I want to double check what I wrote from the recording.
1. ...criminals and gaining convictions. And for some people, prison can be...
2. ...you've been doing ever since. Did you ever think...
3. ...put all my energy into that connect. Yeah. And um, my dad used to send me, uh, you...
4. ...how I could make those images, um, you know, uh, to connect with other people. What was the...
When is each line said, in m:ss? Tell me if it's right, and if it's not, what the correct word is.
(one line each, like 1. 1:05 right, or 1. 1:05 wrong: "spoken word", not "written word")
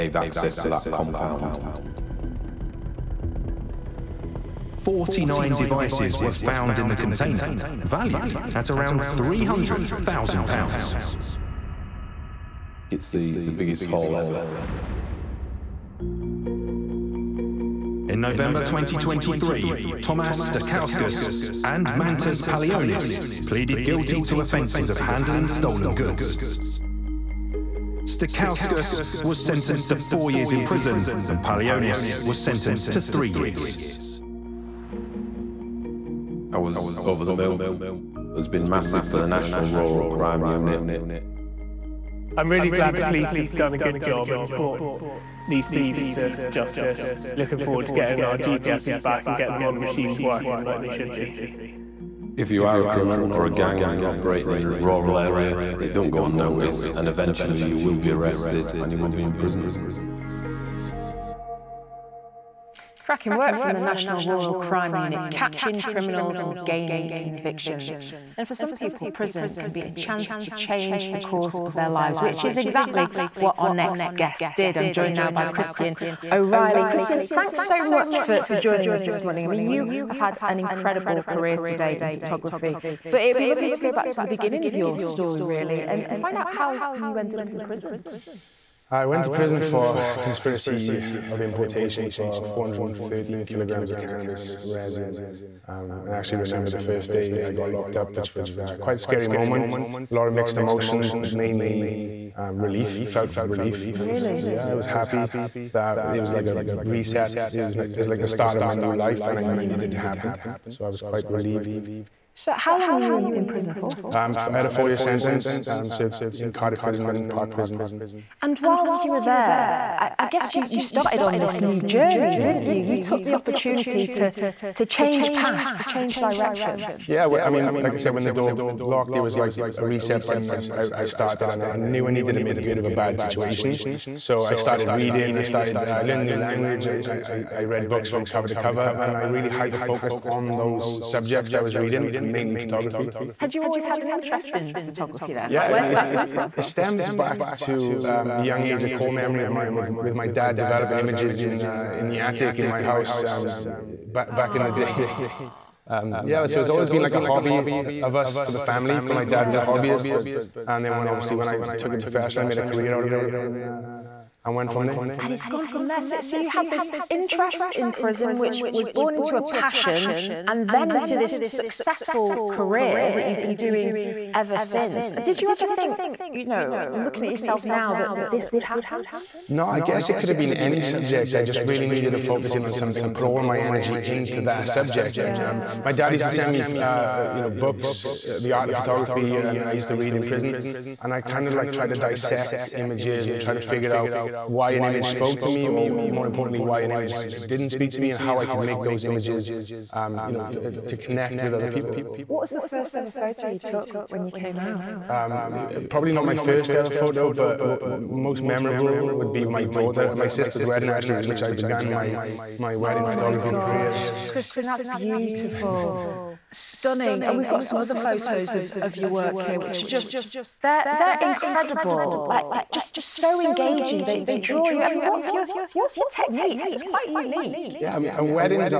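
1. 1:05 right
2. 2:53 right
3. 3:03 wrong: "subject", not "connect"
4. 3:18 right.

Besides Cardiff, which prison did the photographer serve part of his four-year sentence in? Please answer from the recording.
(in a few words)
Parc Prison.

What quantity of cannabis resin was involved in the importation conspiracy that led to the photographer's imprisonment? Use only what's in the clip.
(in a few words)
413 kilograms.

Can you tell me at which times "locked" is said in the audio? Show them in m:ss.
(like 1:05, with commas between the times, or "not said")
1:37, 2:08.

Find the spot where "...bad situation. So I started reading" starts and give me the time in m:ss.
2:12.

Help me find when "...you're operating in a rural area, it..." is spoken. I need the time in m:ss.
0:53.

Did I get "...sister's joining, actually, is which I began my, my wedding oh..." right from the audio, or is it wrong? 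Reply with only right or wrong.
wrong.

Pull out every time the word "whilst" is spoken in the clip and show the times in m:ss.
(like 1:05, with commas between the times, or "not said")
1:58.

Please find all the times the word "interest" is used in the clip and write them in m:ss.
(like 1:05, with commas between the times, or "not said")
2:24, 2:47.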